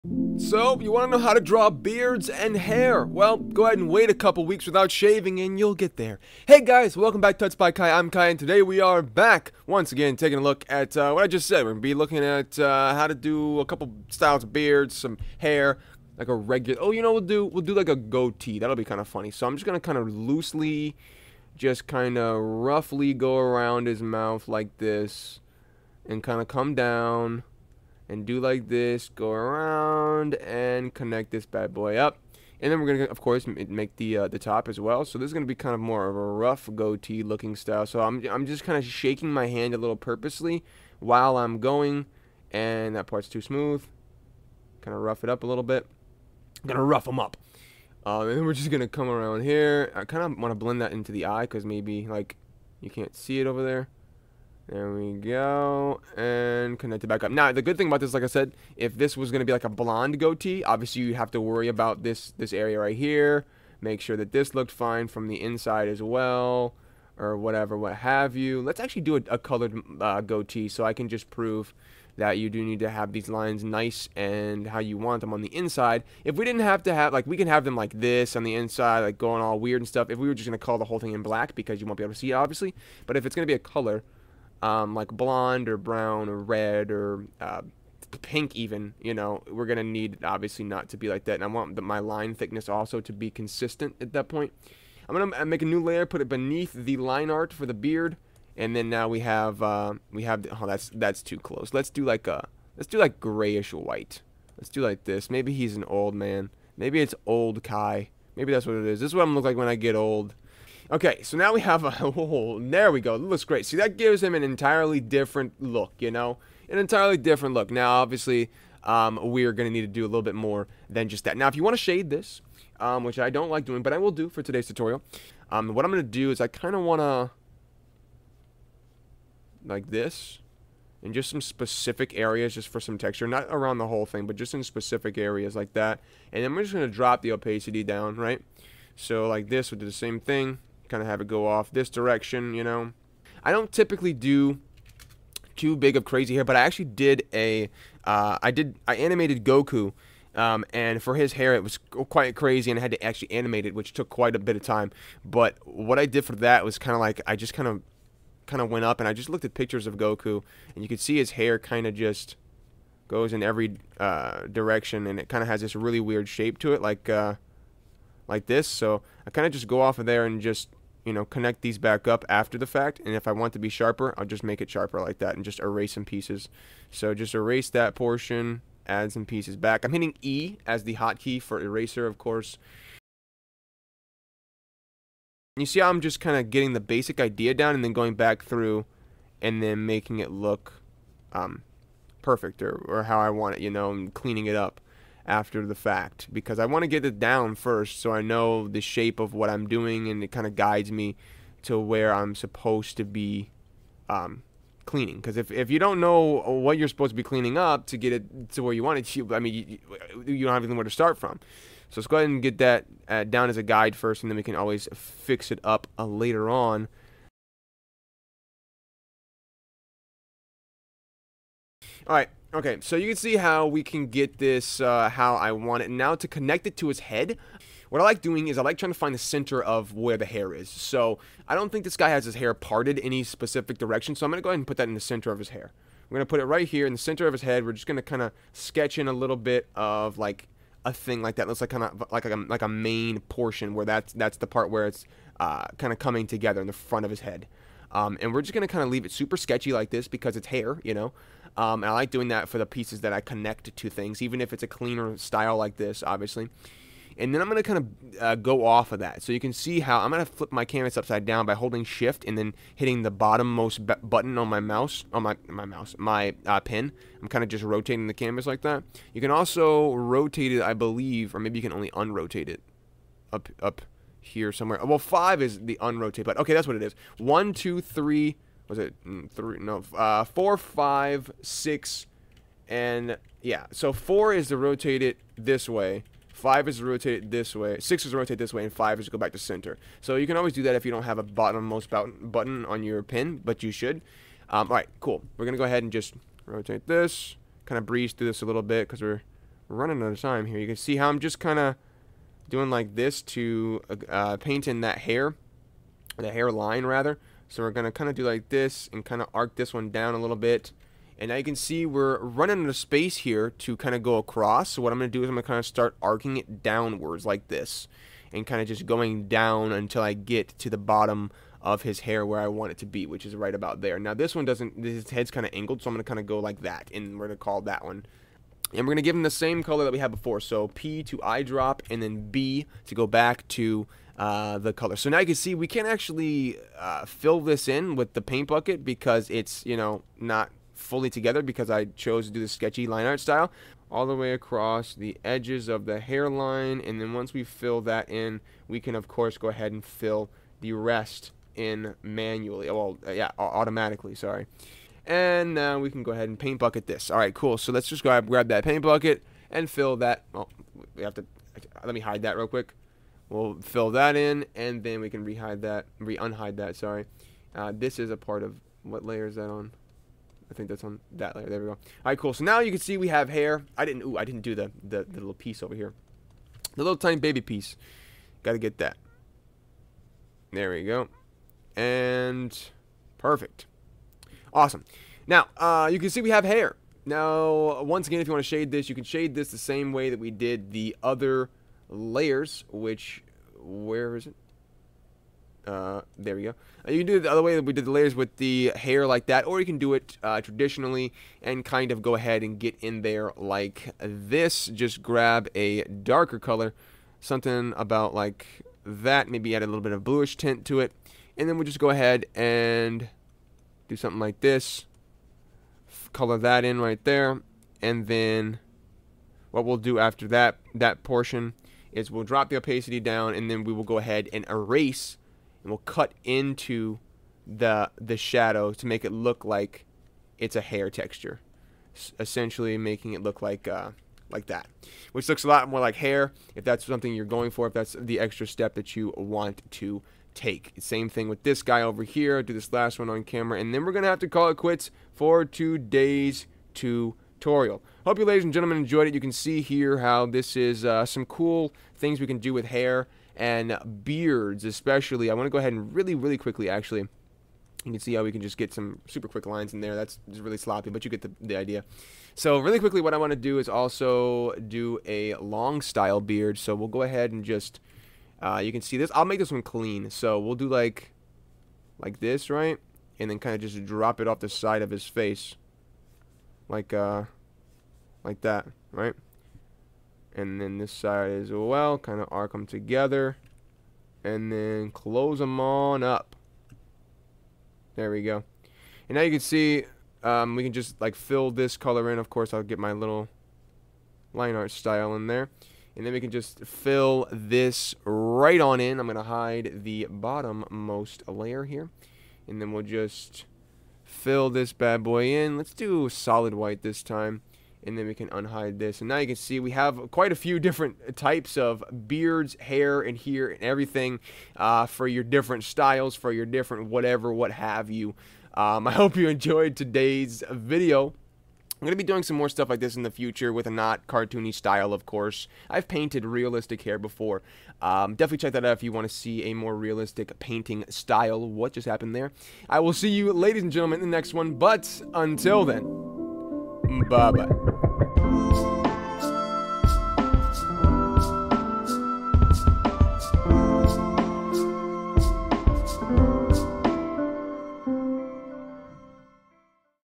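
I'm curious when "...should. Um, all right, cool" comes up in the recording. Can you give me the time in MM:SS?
04:53.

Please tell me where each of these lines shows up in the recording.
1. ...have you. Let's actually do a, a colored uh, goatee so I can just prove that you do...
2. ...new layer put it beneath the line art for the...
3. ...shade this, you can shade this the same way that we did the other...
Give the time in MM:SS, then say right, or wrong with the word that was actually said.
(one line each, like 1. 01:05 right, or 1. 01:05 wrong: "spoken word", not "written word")
1. 01:07 right
2. 01:35 right
3. 06:28 right.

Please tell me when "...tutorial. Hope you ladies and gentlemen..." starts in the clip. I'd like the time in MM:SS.
07:26.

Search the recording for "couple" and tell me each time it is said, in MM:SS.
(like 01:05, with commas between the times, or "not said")
00:04, 00:13.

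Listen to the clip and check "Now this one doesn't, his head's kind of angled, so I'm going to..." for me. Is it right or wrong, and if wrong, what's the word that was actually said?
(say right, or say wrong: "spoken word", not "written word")
right.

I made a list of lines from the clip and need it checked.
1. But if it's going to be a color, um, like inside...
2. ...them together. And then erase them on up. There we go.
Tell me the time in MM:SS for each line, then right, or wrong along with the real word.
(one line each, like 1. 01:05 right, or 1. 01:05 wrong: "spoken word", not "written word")
1. 01:23 wrong: "blonde", not "inside"
2. 08:02 wrong: "close", not "erase".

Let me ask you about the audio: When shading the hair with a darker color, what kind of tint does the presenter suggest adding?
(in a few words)
Bluish tint.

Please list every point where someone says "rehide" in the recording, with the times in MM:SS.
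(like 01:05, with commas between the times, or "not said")
06:05.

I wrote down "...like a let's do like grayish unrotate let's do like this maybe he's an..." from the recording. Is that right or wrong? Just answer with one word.
wrong.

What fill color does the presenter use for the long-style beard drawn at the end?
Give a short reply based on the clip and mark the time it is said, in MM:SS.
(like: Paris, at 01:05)
Solid white, at 08:26.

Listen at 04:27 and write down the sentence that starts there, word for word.
I'm kind of just rotating the canvas like that.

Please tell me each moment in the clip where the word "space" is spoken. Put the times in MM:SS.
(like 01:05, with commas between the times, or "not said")
05:12.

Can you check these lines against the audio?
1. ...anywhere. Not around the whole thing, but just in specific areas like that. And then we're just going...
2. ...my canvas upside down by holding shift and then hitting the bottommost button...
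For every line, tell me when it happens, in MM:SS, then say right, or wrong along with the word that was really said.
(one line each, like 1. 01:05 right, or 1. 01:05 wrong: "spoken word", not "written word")
1. 02:12 wrong: "texture", not "anywhere"
2. 04:20 right.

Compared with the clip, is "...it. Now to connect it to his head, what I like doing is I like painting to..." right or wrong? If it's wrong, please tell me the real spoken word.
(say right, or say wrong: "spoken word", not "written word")
wrong: "trying", not "painting".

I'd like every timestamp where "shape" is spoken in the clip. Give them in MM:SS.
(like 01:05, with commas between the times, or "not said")
02:46, 03:18.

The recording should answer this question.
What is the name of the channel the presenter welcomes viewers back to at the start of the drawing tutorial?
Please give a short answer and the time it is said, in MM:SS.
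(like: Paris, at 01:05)
Tuts by Kai, at 00:07.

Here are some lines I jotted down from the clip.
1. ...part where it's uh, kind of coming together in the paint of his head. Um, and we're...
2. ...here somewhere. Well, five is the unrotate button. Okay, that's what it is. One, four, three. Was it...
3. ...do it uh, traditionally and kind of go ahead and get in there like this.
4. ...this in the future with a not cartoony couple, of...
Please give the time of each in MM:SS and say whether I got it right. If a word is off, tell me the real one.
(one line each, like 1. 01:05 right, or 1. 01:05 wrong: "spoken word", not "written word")
1. 04:04 wrong: "front", not "paint"
2. 04:34 wrong: "two", not "four"
3. 06:39 right
4. 08:42 wrong: "style", not "couple".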